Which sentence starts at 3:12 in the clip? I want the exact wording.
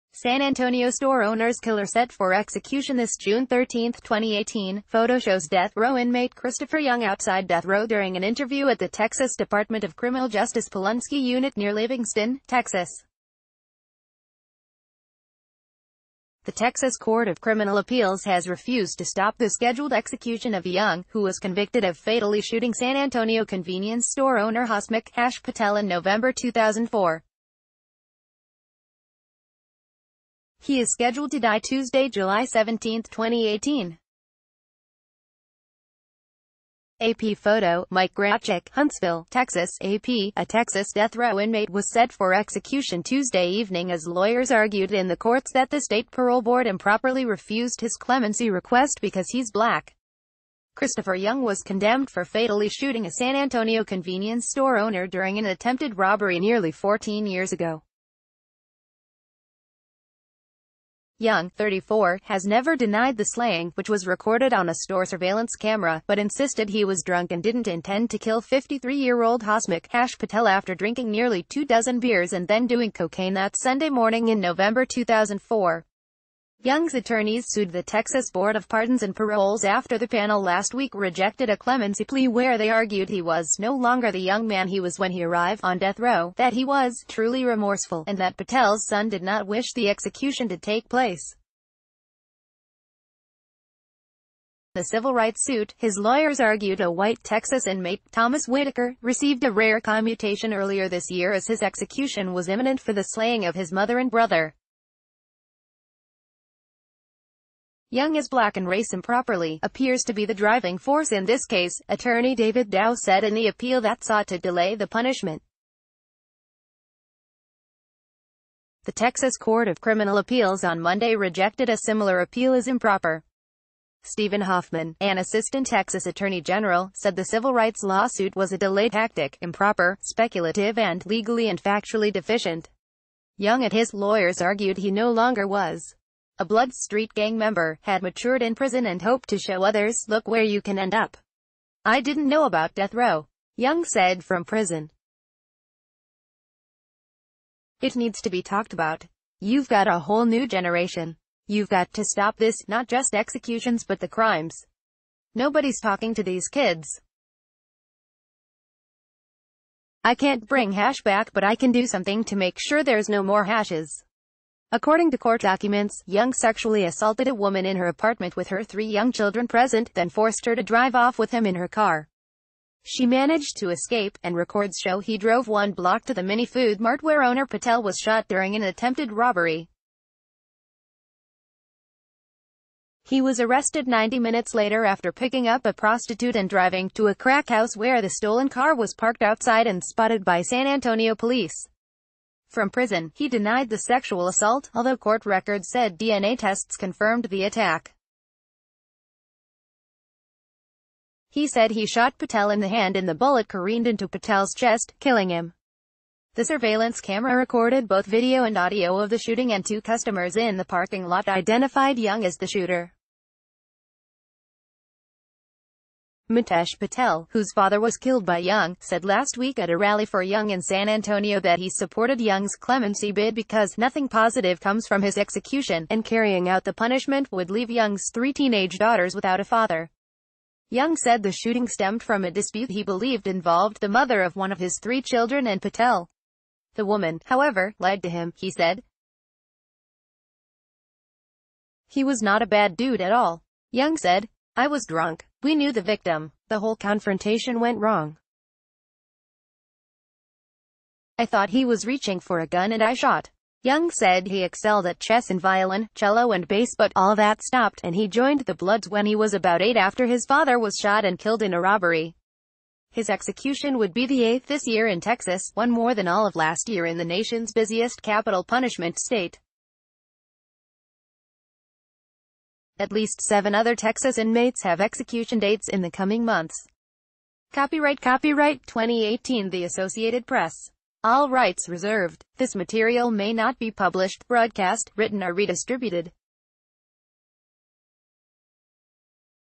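From prison, he denied the sexual assault, although court records said DNA tests confirmed the attack.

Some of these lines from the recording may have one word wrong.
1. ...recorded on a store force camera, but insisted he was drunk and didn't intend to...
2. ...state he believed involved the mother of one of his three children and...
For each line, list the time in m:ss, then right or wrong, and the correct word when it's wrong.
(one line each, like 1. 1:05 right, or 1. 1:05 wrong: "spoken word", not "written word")
1. 1:04 wrong: "surveillance", not "force"
2. 3:52 wrong: "dispute", not "state".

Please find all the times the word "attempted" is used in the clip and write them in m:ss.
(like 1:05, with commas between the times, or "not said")
0:55, 2:58.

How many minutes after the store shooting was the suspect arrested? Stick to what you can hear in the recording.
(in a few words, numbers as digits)
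90.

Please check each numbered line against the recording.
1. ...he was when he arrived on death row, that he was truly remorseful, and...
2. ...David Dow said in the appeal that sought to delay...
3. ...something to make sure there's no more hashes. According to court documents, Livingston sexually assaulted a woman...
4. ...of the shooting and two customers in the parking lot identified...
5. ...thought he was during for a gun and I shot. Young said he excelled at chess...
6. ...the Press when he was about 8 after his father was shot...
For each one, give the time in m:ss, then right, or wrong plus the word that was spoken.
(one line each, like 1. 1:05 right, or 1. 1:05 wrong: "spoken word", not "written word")
1. 1:24 right
2. 1:52 right
3. 2:41 wrong: "Young", not "Livingston"
4. 3:28 right
5. 4:11 wrong: "reaching", not "during"
6. 4:18 wrong: "Bloods", not "Press".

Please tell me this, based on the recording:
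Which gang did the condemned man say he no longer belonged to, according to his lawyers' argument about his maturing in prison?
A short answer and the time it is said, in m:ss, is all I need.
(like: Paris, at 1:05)
Blood Street gang, at 2:16.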